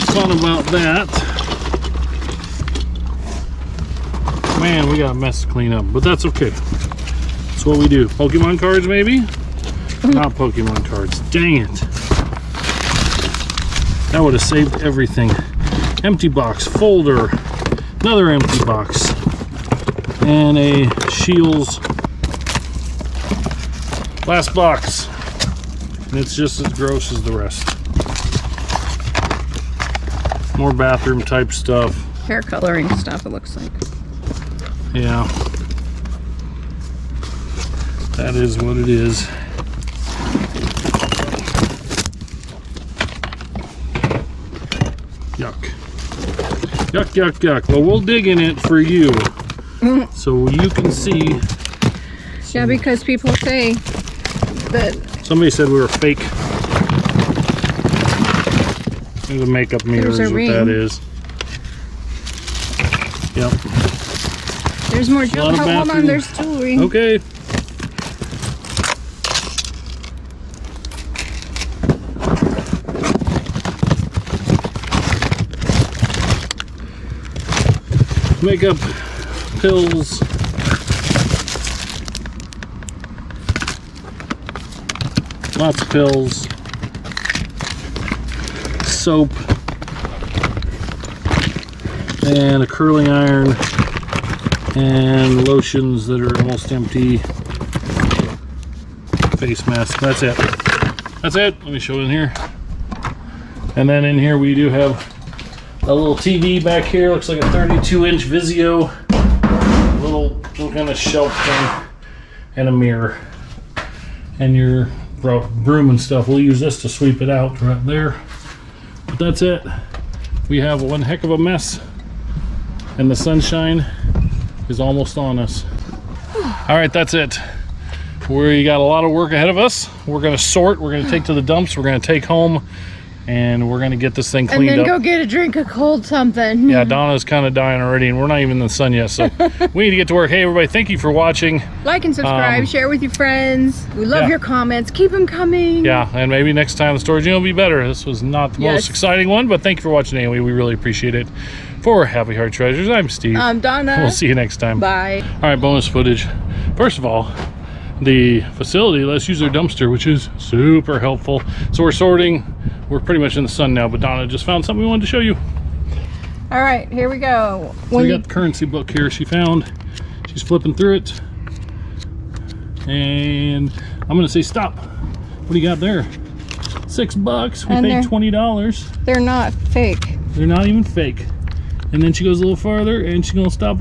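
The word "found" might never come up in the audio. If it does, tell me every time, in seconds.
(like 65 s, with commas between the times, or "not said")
164 s, 169 s.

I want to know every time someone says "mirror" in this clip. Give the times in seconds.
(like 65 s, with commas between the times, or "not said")
59 s, 112 s.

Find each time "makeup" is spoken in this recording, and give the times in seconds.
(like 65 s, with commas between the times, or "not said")
59 s, 78 s.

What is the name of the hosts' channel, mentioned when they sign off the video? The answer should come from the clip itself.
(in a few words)
Happy Heart Treasures.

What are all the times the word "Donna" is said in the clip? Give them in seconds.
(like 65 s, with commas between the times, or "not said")
136 s, 153 s, 164 s.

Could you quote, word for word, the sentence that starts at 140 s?
Hey, everybody, thank you for watching.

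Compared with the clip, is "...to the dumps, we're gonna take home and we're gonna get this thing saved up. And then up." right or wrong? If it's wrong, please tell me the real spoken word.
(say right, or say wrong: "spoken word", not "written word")
wrong: "cleaned", not "saved".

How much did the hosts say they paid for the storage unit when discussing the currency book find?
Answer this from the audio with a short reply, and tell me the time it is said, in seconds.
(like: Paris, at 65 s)
$20, at 178 s.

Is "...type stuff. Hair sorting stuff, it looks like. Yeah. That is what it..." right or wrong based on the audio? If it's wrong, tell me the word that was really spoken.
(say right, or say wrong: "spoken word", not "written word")
wrong: "coloring", not "sorting".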